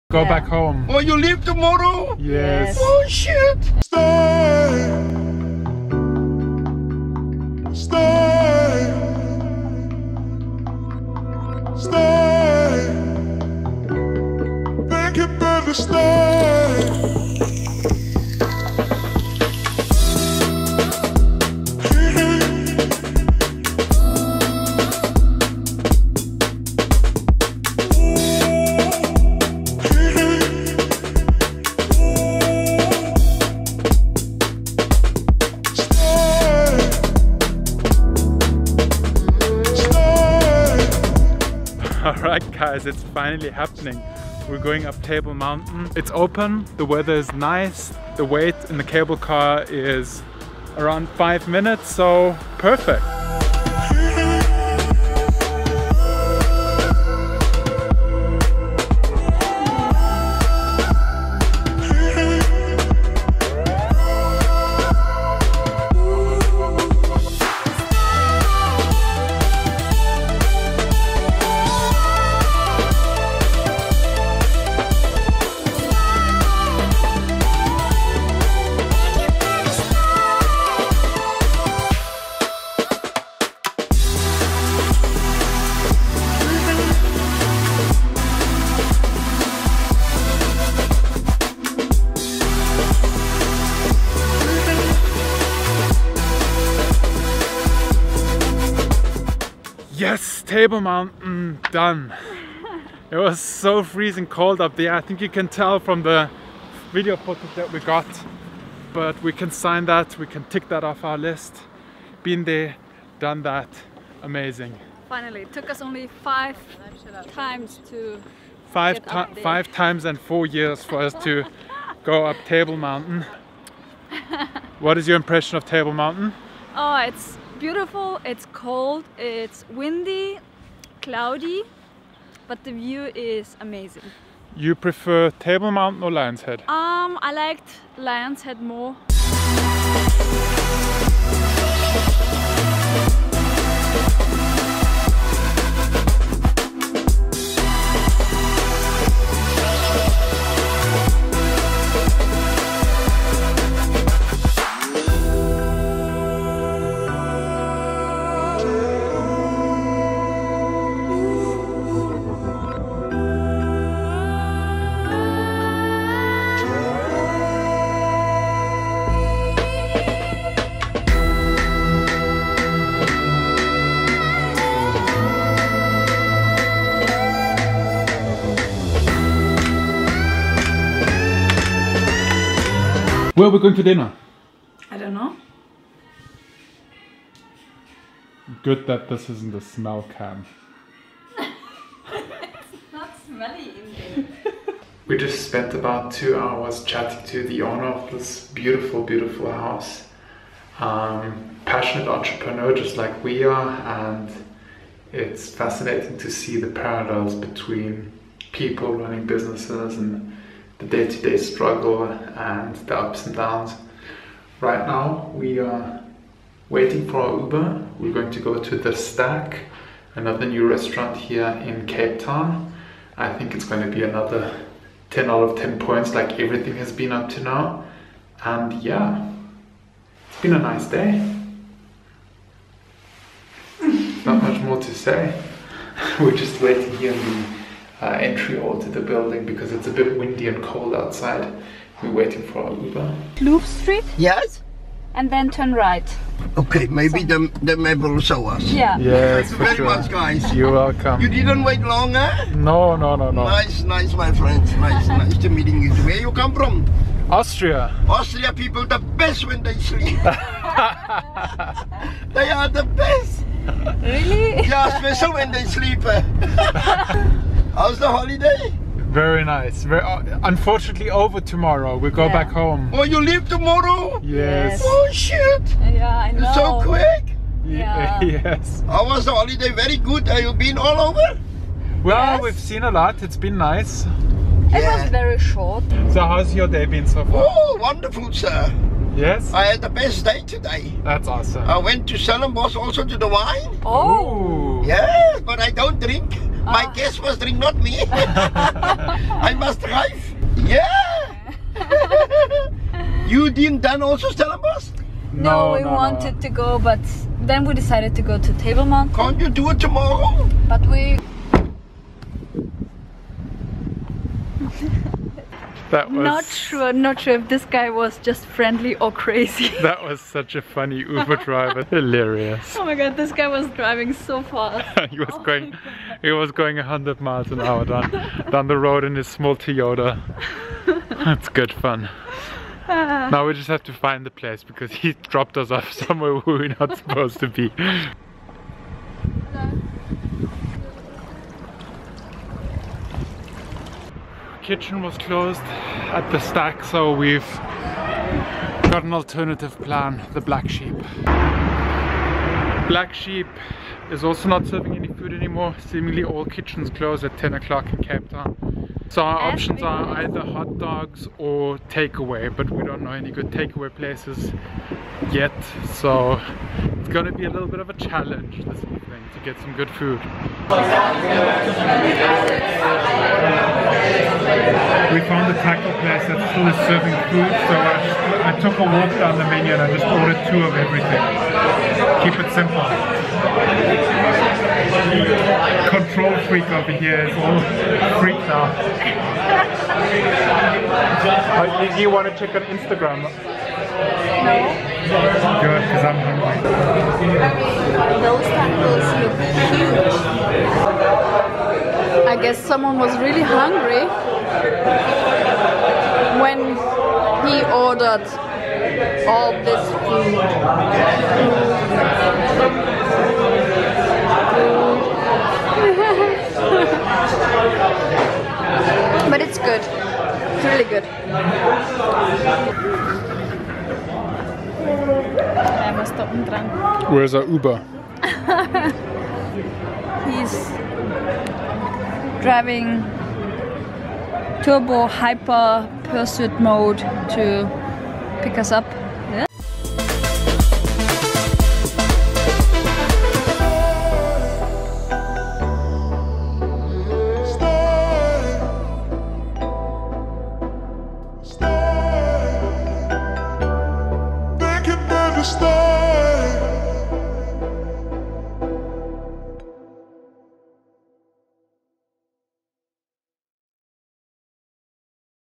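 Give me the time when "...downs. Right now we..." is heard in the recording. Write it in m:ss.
3:33.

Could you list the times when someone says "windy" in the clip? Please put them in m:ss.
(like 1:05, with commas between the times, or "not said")
2:09, 4:00.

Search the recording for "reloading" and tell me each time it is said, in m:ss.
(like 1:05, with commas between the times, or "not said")
not said.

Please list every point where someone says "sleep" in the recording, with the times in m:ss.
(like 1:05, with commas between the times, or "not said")
4:19, 4:25.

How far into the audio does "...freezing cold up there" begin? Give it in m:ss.
1:43.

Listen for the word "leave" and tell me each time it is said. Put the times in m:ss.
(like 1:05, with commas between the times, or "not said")
0:01, 4:33.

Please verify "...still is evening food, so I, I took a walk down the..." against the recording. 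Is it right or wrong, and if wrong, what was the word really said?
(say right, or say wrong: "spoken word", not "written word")
wrong: "serving", not "evening".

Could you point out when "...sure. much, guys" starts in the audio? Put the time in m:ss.
4:09.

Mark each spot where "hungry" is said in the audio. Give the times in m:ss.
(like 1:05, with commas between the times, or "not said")
6:36, 6:43.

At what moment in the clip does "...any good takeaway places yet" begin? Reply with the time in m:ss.
6:03.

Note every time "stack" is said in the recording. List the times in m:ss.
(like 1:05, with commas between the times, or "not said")
3:38, 5:46.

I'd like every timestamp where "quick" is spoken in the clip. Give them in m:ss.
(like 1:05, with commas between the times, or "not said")
4:36.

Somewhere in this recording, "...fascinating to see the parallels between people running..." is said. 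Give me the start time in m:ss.
3:25.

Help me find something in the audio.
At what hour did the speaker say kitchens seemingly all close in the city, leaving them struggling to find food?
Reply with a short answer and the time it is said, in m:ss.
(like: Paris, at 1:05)
10 o'clock, at 5:57.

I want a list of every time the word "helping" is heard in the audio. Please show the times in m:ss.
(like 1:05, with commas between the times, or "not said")
not said.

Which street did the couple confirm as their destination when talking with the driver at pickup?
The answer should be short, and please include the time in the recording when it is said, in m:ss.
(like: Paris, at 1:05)
Loop Street, at 4:03.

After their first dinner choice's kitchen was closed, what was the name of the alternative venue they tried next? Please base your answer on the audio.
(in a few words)
The Black Sheep.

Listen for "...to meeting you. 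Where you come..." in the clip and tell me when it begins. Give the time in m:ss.
4:15.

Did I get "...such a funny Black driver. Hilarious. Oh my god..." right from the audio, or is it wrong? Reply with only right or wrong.
wrong.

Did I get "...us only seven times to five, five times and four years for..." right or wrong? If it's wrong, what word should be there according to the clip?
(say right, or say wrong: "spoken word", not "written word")
wrong: "five", not "seven".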